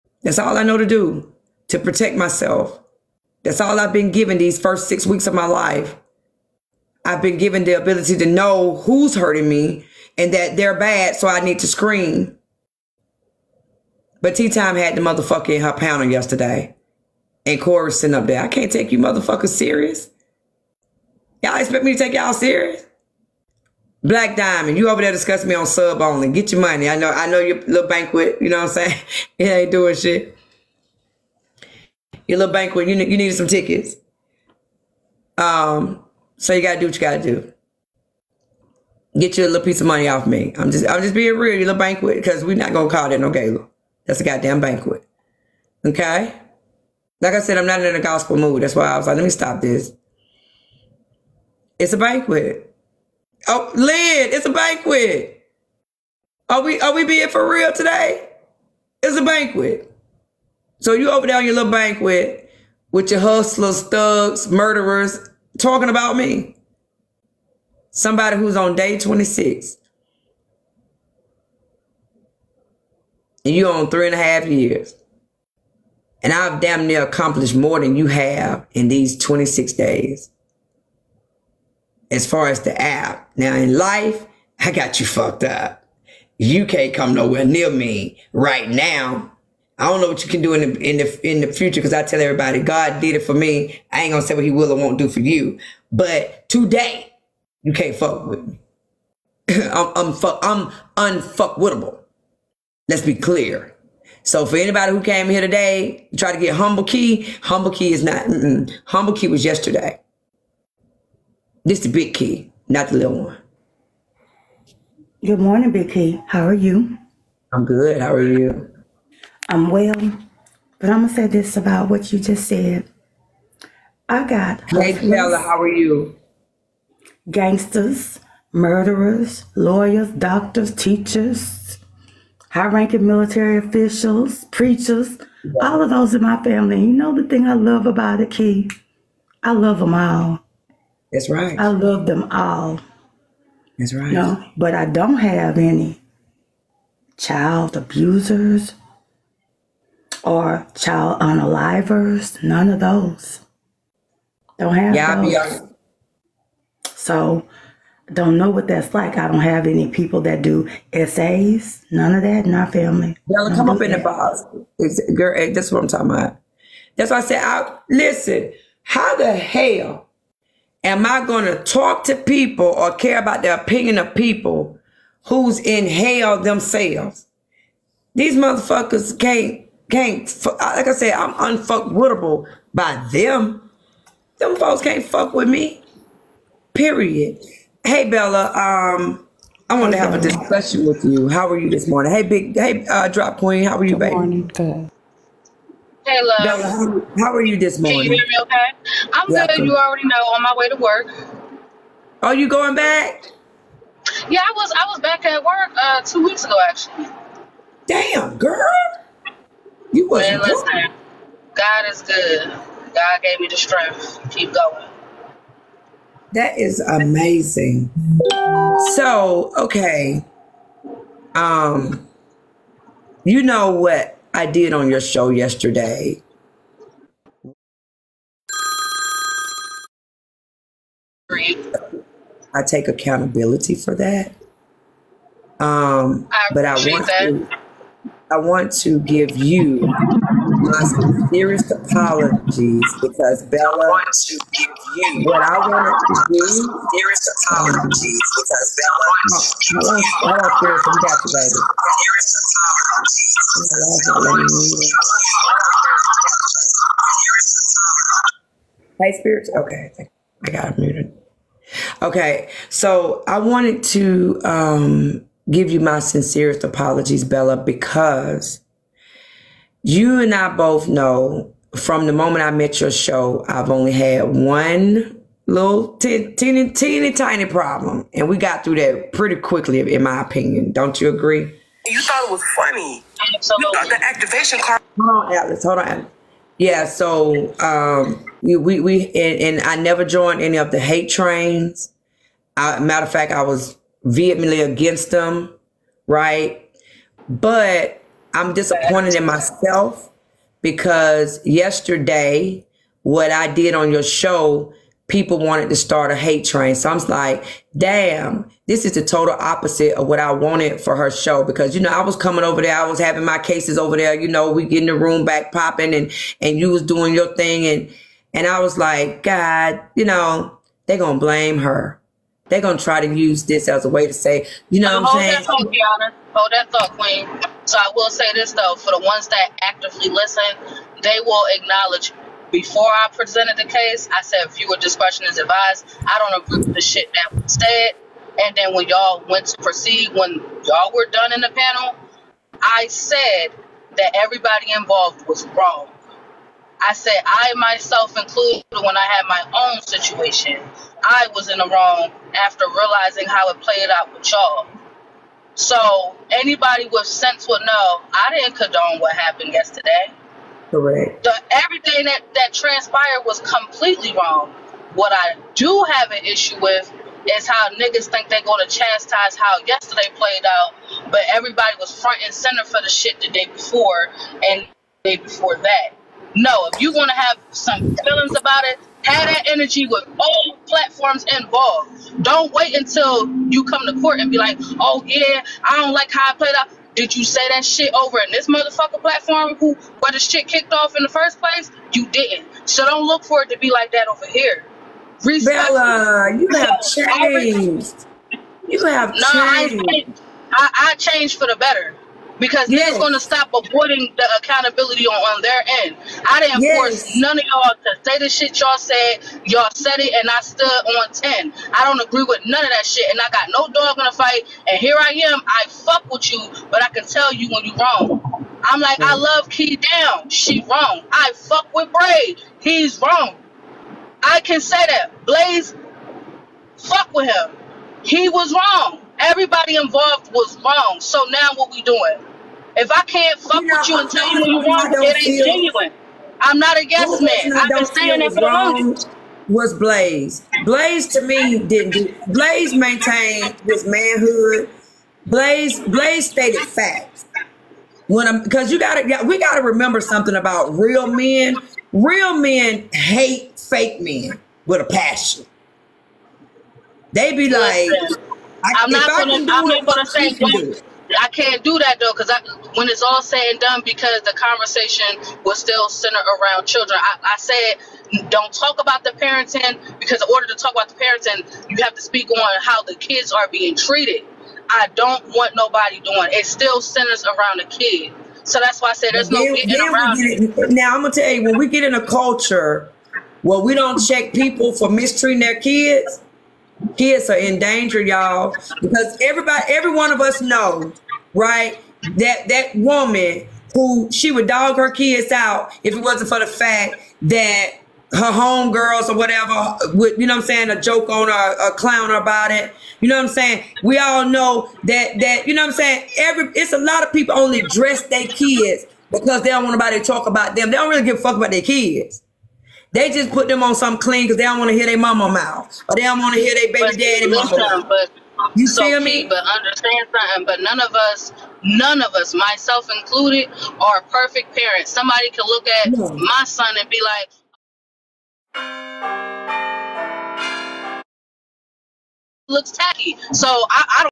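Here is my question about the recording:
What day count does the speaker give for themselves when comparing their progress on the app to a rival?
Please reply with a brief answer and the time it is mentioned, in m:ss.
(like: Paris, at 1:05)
26, at 1:08.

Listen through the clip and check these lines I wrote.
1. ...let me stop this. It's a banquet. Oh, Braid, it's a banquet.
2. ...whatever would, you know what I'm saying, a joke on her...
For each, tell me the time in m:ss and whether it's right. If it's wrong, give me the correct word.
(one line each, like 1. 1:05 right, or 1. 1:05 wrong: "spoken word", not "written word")
1. 0:49 wrong: "Lynn", not "Braid"
2. 8:19 right.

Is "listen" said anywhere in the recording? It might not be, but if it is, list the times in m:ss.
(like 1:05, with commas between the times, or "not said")
2:47, 5:30, 7:38.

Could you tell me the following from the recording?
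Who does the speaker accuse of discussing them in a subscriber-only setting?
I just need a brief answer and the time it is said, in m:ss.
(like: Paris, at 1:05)
Black Diamond, at 0:24.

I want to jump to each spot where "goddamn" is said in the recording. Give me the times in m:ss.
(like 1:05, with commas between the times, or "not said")
0:44.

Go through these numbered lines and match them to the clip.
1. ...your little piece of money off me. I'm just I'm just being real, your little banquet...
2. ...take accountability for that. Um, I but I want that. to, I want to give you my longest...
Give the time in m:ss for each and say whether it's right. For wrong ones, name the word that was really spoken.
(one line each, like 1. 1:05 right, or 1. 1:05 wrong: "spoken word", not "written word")
1. 0:39 right
2. 3:52 wrong: "sincerest", not "longest".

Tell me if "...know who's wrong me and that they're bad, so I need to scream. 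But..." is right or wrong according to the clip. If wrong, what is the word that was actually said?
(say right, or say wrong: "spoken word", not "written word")
wrong: "hurting", not "wrong".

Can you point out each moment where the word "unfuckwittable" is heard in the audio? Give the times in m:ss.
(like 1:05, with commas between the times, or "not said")
1:40, 3:01.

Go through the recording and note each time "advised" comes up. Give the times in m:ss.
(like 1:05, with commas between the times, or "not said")
5:35.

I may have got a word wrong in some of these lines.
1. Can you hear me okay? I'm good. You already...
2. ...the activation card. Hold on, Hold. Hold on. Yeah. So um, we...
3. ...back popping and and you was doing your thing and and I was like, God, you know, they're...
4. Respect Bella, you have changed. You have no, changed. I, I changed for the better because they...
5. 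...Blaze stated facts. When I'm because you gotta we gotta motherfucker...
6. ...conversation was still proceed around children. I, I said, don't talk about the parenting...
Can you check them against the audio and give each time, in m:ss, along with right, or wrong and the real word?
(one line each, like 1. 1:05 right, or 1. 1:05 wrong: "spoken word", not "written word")
1. 3:18 right
2. 4:43 wrong: "Atlas", not "Hold"
3. 5:15 right
4. 6:35 right
5. 7:25 wrong: "remember", not "motherfucker"
6. 7:44 wrong: "centered", not "proceed".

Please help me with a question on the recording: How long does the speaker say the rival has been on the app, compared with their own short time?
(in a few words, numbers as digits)
3 and a half years.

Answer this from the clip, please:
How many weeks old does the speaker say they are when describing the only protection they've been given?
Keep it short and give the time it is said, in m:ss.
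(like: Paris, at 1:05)
6, at 0:04.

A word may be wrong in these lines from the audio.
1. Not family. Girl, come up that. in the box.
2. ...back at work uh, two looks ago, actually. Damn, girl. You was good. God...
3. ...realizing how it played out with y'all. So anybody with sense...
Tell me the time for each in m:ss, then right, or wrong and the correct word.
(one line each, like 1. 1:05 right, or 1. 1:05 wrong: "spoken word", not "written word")
1. 2:42 right
2. 3:24 wrong: "weeks", not "looks"
3. 5:52 right.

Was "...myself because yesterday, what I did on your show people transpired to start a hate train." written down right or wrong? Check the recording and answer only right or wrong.
wrong.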